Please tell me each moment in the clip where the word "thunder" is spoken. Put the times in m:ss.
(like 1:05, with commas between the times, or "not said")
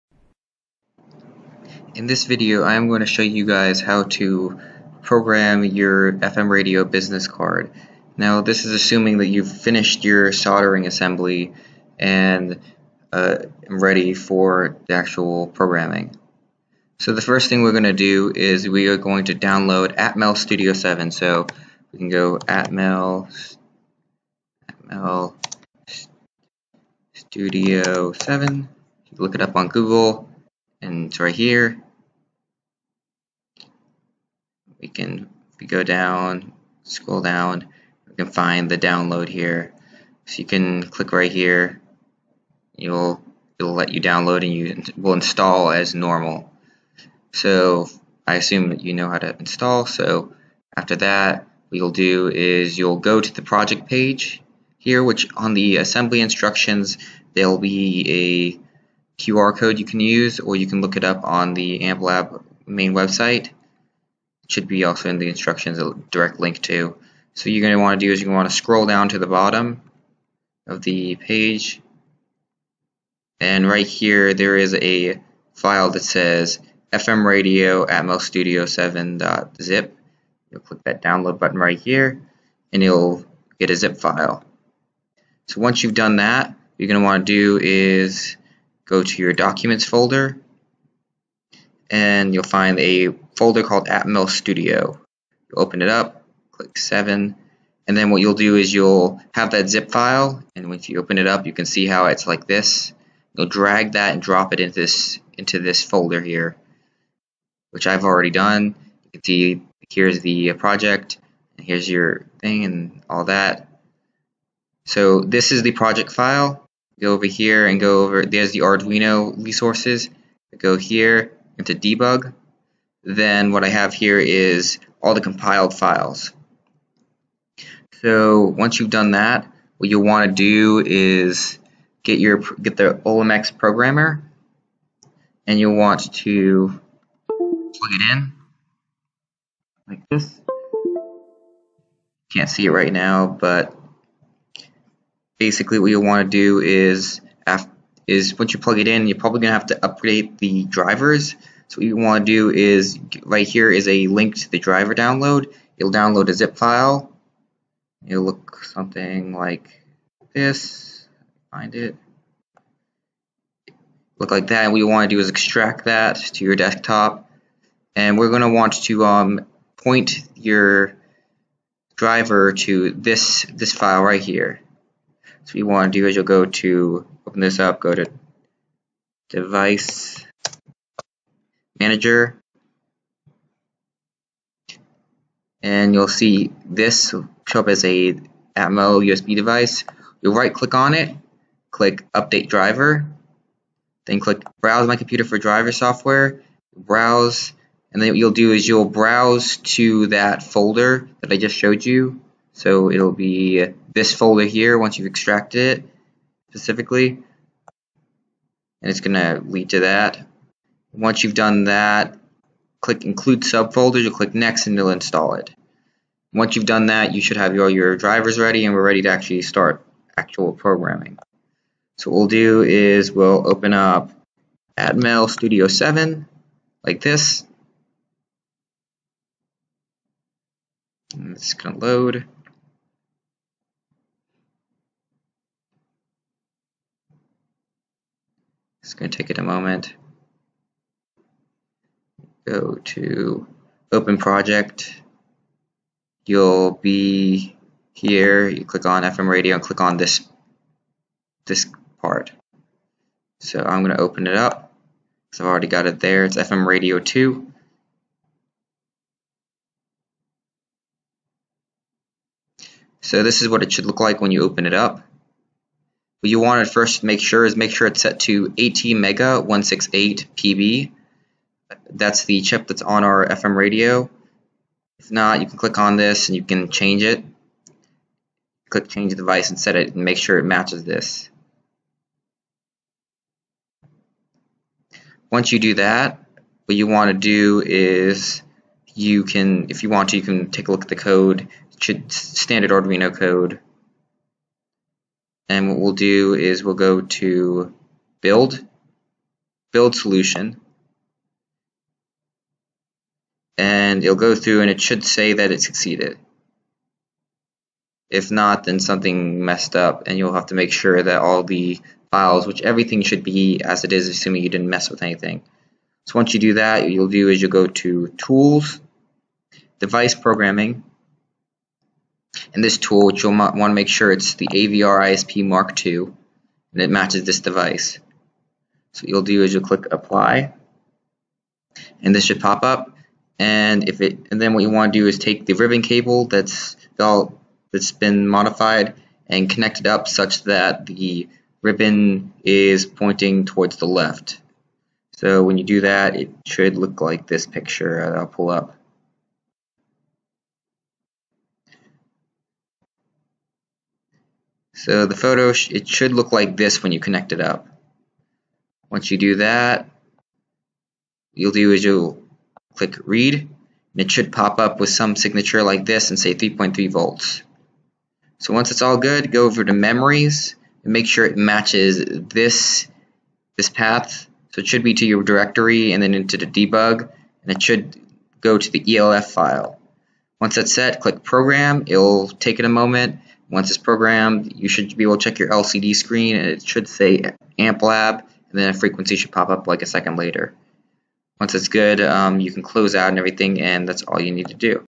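not said.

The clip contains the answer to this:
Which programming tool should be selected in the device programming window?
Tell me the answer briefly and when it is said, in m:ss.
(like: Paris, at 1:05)
AVR ISP Mark II, at 5:24.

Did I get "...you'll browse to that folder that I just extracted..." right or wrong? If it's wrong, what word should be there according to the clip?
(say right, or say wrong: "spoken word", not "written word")
wrong: "showed", not "extracted".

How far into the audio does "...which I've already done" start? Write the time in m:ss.
1:47.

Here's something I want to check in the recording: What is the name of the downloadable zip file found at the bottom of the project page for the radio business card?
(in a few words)
FM radio Atmel Studio 7.zip.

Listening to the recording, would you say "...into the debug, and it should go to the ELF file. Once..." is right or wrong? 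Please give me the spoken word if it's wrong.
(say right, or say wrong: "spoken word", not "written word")
right.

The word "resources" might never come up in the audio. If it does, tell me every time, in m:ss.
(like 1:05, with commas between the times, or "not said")
1:59.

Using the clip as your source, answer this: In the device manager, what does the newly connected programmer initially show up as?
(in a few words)
Atmel USB device.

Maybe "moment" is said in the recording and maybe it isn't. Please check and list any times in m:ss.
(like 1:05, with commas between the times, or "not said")
3:59, 6:22.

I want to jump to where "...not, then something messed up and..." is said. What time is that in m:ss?
5:08.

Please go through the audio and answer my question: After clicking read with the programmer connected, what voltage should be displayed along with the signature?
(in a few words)
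3.3 volts.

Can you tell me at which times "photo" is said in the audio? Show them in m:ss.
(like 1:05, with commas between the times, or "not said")
5:55.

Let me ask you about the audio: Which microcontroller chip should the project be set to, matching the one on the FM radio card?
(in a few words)
ATmega 168 PB.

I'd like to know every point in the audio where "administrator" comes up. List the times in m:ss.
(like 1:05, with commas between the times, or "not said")
not said.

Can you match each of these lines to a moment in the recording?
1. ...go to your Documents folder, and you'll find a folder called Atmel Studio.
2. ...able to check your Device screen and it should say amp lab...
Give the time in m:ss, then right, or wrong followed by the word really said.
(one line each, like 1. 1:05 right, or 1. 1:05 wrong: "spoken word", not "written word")
1. 1:28 right
2. 6:25 wrong: "LCD", not "Device".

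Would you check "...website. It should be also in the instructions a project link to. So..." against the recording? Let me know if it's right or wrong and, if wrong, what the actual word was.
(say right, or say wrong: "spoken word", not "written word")
wrong: "direct", not "project".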